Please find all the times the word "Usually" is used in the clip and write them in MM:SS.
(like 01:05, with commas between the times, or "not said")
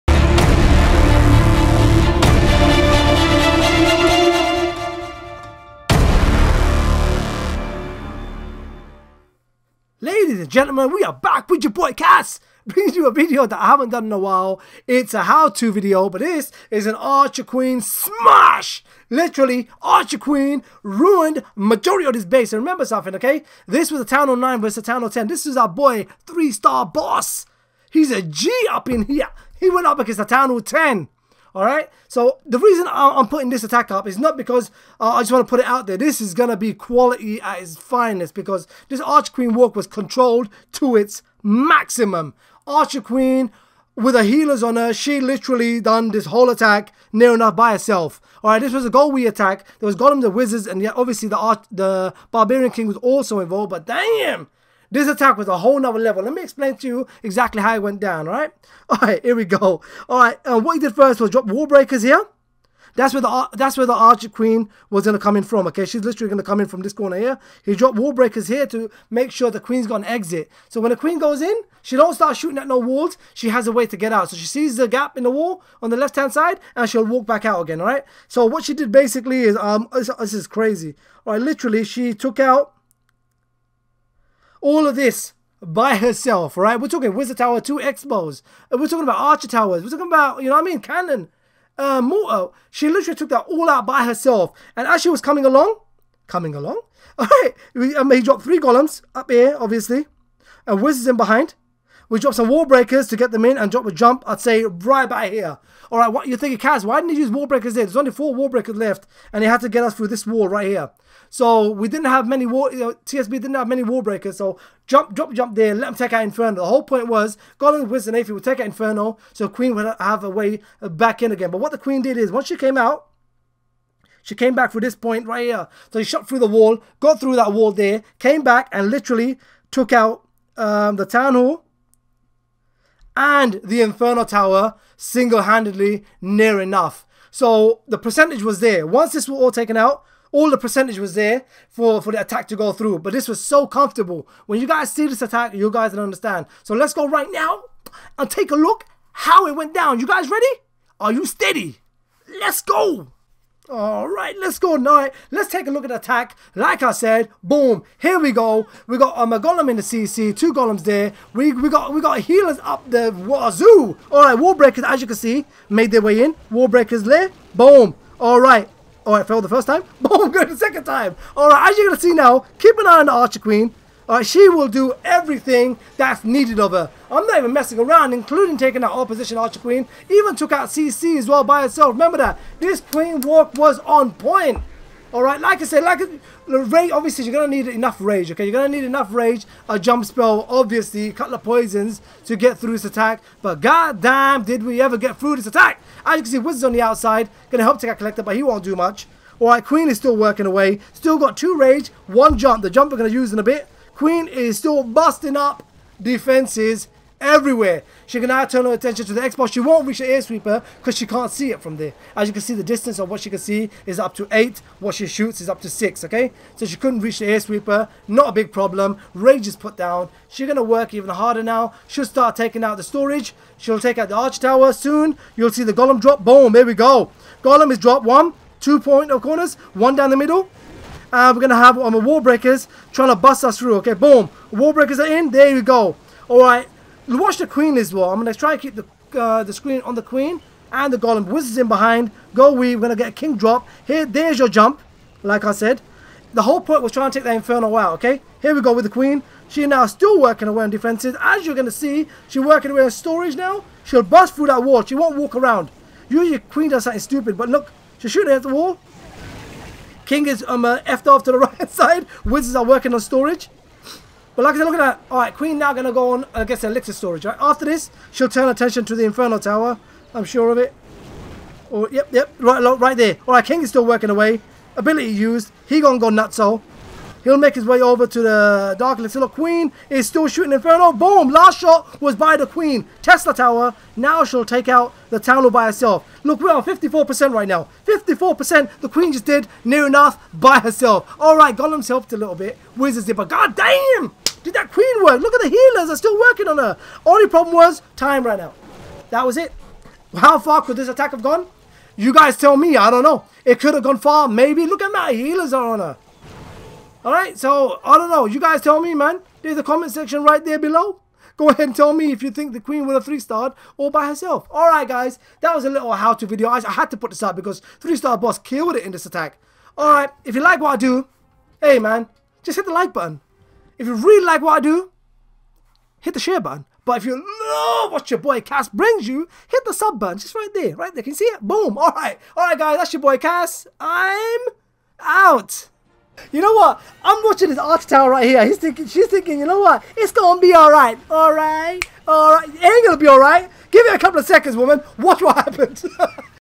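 04:16.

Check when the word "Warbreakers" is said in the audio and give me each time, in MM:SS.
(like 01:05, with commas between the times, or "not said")
03:52.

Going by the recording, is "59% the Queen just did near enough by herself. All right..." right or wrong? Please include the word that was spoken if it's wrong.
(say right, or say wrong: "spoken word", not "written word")
wrong: "54", not "59".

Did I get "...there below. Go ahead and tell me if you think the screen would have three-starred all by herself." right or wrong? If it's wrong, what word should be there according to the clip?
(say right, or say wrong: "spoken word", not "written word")
wrong: "queen", not "screen".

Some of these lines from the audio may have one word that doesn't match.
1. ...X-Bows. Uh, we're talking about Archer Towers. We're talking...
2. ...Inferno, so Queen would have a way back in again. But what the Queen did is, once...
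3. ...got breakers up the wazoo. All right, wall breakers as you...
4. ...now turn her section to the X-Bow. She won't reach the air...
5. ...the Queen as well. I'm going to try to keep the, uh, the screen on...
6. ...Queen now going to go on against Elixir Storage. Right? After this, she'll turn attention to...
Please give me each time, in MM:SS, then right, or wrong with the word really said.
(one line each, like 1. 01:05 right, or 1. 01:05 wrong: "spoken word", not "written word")
1. 01:27 right
2. 01:58 right
3. 02:42 wrong: "healers", not "breakers"
4. 03:28 wrong: "attention", not "section"
5. 03:57 right
6. 04:25 right.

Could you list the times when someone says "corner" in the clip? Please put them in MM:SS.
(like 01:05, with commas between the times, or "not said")
01:06, 03:49.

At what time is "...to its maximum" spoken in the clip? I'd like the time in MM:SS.
00:40.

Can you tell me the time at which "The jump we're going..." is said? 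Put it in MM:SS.
03:22.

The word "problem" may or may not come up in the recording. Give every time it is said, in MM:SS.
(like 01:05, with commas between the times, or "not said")
03:38, 04:57.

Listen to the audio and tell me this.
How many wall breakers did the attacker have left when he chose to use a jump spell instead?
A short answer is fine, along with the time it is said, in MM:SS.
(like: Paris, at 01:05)
4, at 01:48.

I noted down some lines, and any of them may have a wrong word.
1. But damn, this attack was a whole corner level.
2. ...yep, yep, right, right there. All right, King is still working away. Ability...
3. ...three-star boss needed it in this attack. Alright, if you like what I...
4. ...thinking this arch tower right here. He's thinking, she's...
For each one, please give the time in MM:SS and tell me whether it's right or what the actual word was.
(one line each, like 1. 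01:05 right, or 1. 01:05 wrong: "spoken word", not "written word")
1. 00:53 wrong: "nother", not "corner"
2. 04:31 right
3. 05:17 wrong: "killed", not "needed"
4. 05:37 wrong: "watching", not "thinking".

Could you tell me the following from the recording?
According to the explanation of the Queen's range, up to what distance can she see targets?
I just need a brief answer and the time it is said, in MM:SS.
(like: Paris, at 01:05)
8, at 03:33.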